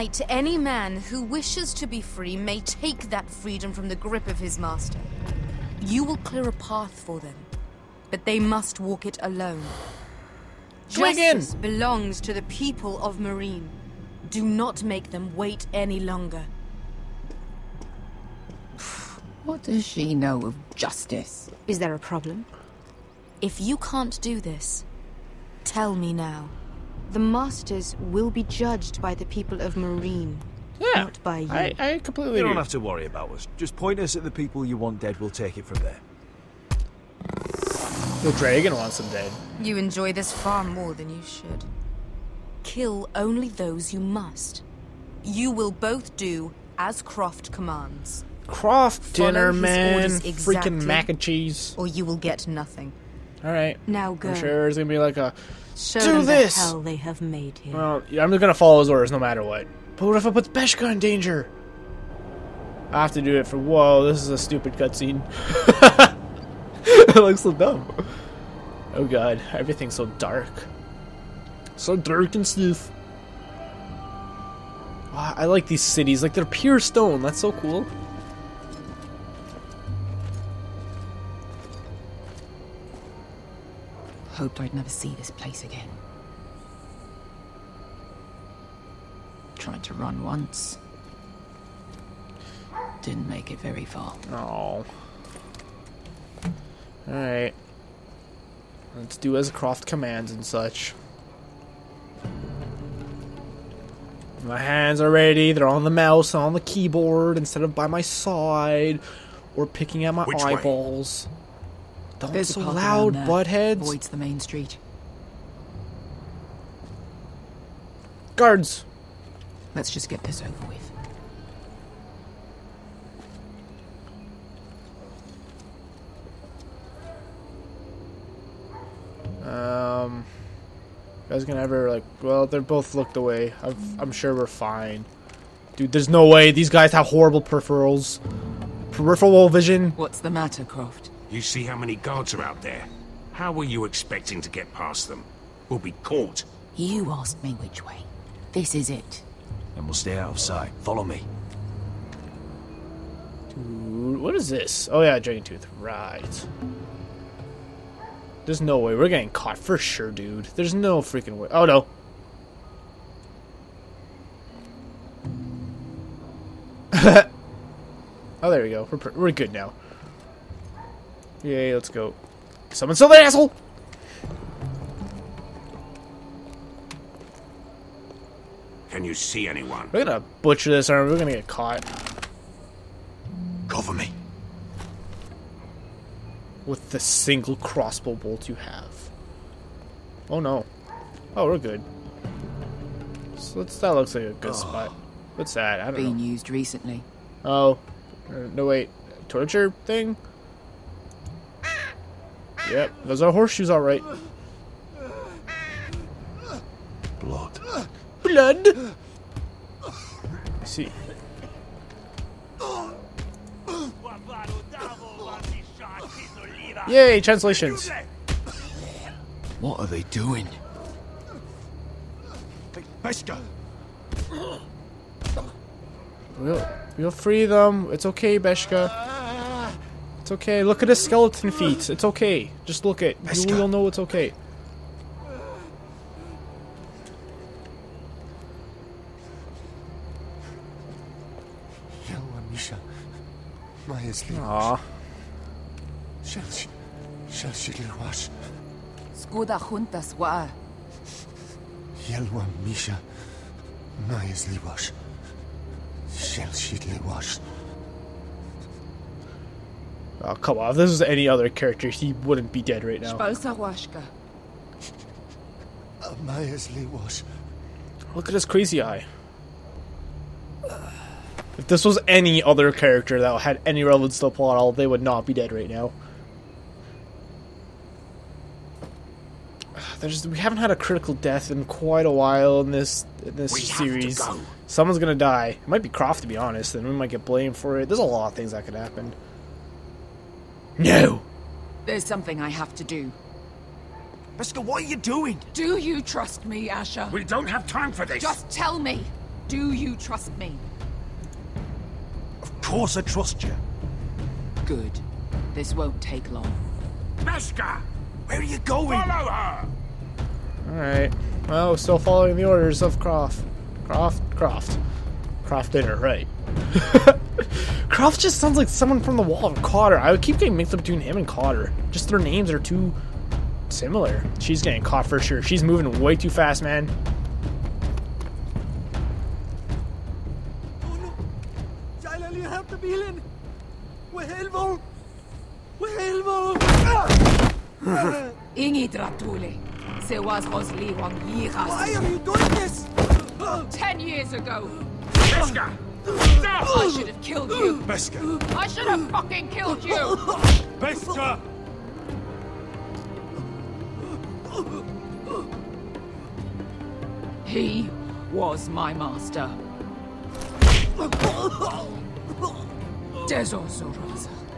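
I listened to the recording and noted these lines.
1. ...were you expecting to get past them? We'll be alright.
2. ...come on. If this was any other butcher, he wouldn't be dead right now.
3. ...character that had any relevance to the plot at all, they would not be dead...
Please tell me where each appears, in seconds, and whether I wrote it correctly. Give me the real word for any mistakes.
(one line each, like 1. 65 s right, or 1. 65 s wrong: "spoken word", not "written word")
1. 143 s wrong: "caught", not "alright"
2. 260 s wrong: "character", not "butcher"
3. 272 s right.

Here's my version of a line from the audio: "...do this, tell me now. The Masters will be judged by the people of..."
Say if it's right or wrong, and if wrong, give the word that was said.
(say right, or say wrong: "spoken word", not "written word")
right.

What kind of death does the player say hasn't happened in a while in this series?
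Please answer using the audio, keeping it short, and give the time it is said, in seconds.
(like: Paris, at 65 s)
Critical death, at 280 s.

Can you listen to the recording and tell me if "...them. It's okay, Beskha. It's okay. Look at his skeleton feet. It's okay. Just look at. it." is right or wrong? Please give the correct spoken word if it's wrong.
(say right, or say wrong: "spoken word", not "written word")
right.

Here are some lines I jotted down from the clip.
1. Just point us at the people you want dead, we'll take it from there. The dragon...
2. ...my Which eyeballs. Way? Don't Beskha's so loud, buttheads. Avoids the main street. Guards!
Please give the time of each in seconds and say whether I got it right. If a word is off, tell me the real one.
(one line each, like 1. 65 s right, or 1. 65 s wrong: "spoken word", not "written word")
1. 33 s right
2. 110 s wrong: "There", not "Beskha".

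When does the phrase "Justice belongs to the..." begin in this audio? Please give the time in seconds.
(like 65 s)
10 s.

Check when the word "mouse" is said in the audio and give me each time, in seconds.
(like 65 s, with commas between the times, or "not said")
105 s.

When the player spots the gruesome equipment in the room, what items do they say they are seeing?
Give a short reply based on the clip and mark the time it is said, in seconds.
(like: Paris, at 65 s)
Horseshoes, at 203 s.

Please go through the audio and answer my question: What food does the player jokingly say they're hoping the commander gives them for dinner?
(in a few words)
Mac and cheese.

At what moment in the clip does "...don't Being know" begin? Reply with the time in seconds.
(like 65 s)
195 s.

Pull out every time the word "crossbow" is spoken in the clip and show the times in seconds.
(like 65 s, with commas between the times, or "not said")
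187 s.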